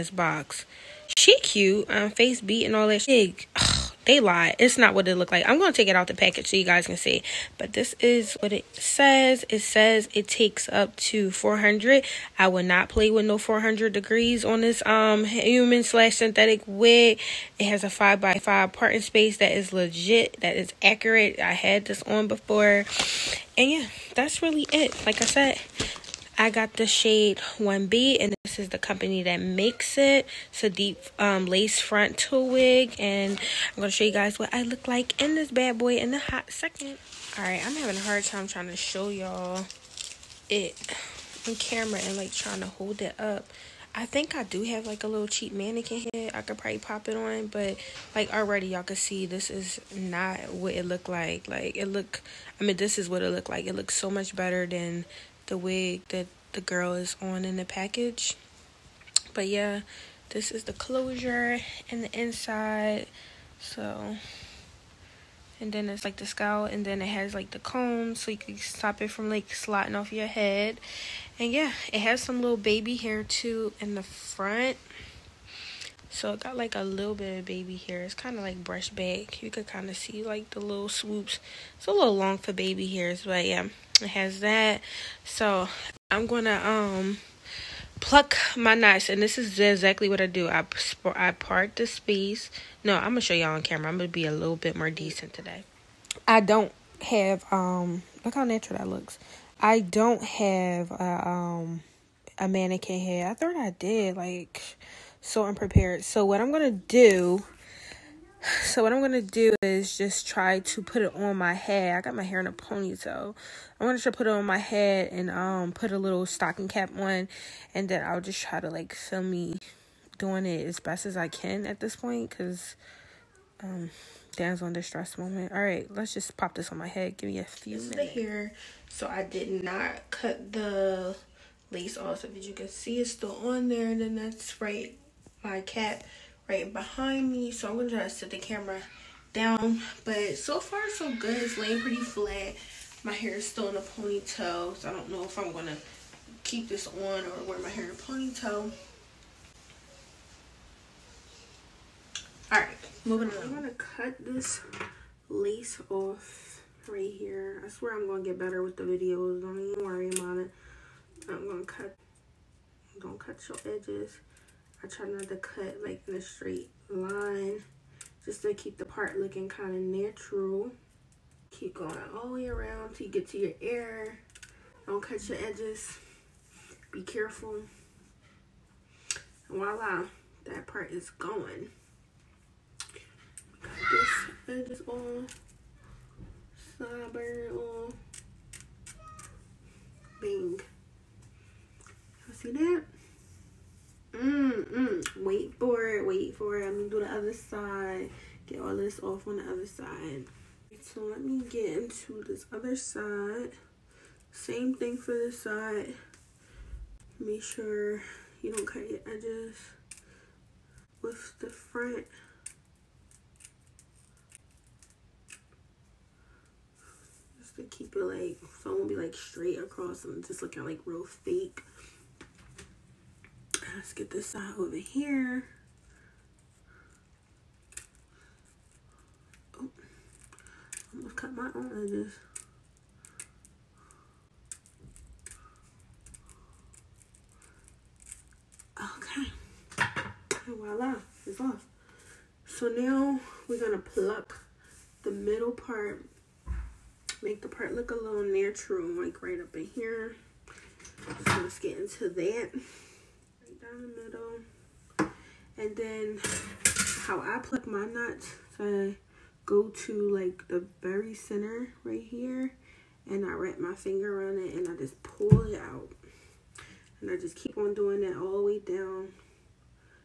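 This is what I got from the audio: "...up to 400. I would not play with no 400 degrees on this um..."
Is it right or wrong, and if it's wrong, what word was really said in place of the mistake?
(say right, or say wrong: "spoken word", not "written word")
right.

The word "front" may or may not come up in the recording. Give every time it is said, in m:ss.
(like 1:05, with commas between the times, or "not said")
1:14, 3:31.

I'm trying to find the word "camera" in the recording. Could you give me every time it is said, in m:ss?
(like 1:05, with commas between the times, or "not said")
0:41, 1:33, 2:18.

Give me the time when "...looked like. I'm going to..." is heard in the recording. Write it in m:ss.
0:05.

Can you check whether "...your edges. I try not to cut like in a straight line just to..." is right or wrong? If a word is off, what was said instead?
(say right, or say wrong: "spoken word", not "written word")
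right.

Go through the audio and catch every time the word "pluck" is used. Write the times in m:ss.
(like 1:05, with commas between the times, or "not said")
1:28, 4:03, 4:17.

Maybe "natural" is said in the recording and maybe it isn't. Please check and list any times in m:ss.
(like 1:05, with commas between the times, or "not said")
1:38, 2:49, 4:08.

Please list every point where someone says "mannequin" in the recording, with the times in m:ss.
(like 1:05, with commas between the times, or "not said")
0:45, 1:42.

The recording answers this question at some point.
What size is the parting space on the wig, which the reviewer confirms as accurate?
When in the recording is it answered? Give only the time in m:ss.
0:17.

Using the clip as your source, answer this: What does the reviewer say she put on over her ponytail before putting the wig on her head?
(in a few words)
stocking cap.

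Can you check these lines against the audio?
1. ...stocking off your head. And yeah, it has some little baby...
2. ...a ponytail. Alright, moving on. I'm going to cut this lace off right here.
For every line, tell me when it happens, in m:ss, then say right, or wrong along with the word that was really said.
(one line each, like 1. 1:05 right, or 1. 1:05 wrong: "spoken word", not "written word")
1. 1:09 wrong: "slotting", not "stocking"
2. 2:27 right.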